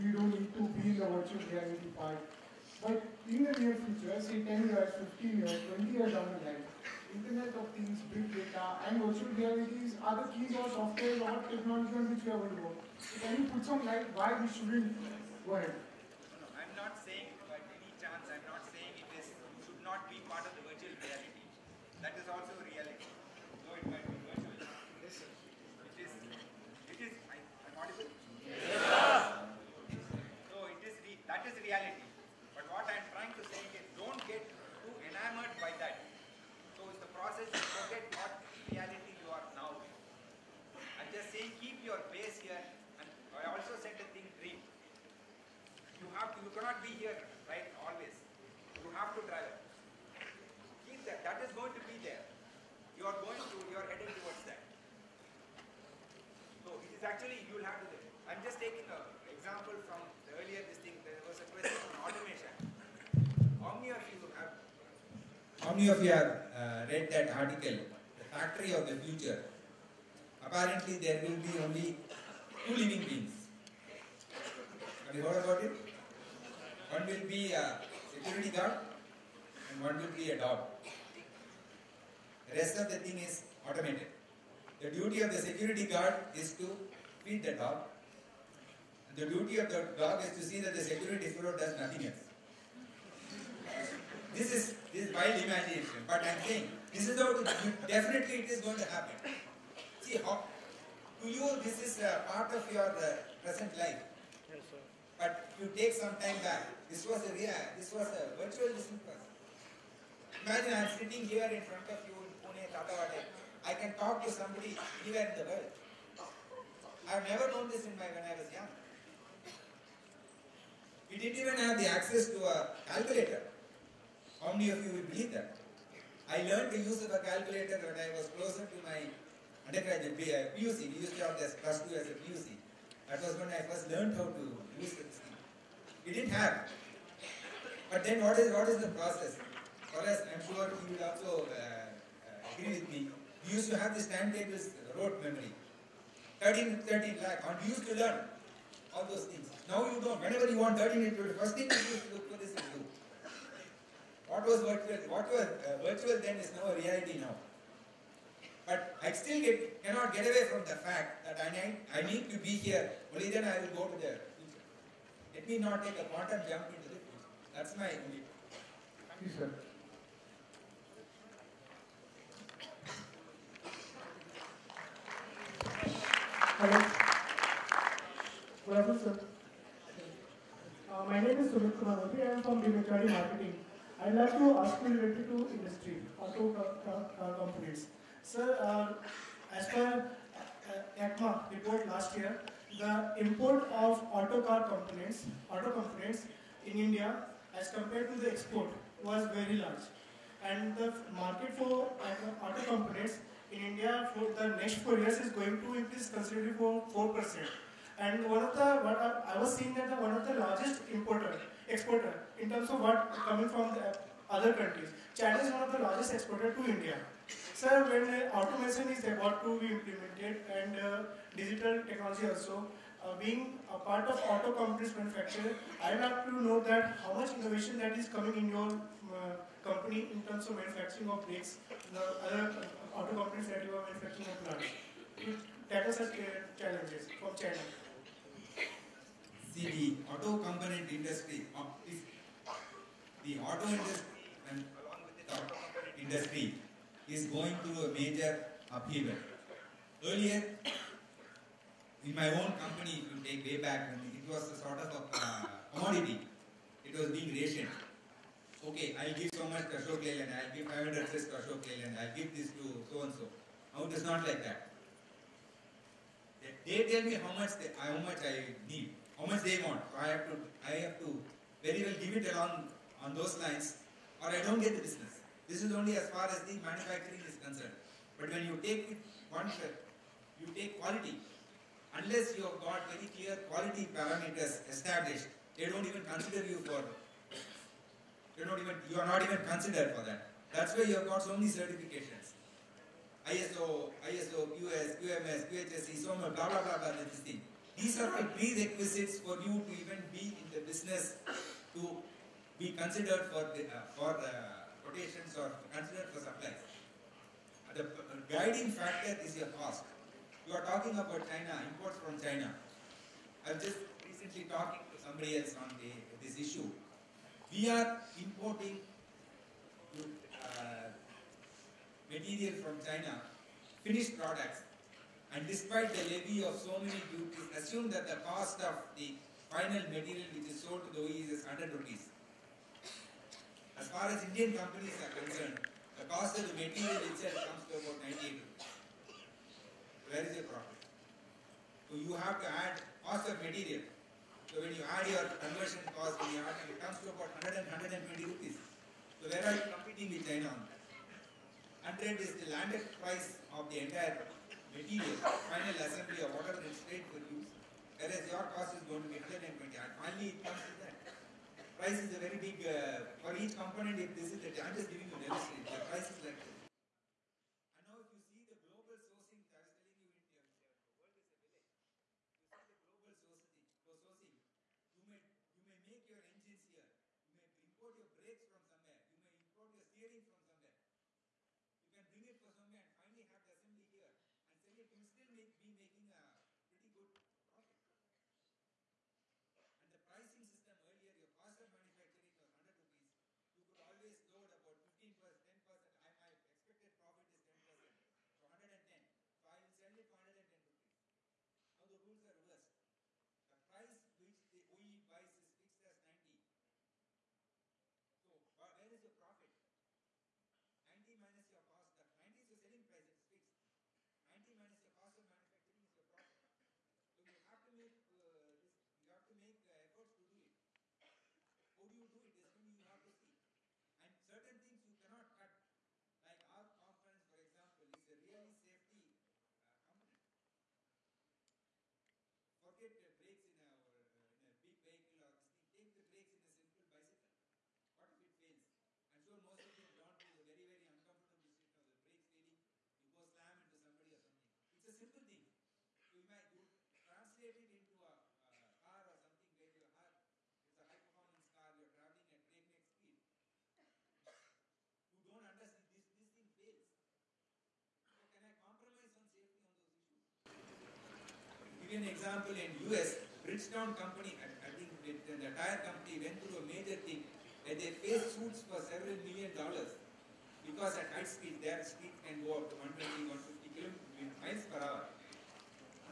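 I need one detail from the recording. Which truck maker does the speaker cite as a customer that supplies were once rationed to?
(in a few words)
Ashok Leyland.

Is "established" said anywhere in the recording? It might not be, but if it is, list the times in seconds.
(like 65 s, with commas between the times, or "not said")
284 s.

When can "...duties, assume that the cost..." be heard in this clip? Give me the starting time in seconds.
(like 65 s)
327 s.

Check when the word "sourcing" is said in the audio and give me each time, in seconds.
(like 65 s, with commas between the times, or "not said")
368 s, 373 s.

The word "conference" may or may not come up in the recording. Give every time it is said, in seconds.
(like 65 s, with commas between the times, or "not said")
426 s.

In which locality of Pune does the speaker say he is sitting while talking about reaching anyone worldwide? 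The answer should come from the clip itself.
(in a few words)
Tathawade.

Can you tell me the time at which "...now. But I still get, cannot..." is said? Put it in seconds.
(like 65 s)
157 s.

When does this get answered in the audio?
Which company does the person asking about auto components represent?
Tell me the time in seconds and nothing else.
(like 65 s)
182 s.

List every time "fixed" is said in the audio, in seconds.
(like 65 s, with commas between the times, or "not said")
405 s, 413 s.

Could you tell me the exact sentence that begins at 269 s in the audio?
So I have to I have to very well give it along on those lines, or I don't get the business.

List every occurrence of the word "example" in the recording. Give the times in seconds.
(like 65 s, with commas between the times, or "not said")
59 s, 427 s, 462 s.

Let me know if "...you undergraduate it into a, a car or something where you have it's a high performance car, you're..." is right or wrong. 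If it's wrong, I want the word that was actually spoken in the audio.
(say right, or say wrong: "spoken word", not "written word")
wrong: "translate", not "undergraduate".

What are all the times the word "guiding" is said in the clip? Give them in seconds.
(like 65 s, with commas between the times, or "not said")
308 s.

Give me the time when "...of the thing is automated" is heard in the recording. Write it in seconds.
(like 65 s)
82 s.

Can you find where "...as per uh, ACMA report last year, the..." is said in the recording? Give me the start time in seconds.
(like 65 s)
189 s.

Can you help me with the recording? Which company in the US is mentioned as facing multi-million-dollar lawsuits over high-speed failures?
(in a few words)
Bridgestone.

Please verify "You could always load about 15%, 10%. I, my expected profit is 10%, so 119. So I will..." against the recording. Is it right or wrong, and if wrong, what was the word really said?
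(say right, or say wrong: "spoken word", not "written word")
wrong: "110", not "119".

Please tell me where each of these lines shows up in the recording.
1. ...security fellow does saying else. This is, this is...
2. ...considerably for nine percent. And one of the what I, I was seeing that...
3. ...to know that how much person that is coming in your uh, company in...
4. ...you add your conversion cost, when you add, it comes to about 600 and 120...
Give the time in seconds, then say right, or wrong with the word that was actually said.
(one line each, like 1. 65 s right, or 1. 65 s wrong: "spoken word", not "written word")
1. 90 s wrong: "nothing", not "saying"
2. 206 s wrong: "four", not "nine"
3. 226 s wrong: "innovation", not "person"
4. 344 s wrong: "100", not "600".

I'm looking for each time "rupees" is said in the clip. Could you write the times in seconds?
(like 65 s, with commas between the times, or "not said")
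261 s, 331 s, 338 s, 348 s, 392 s, 400 s.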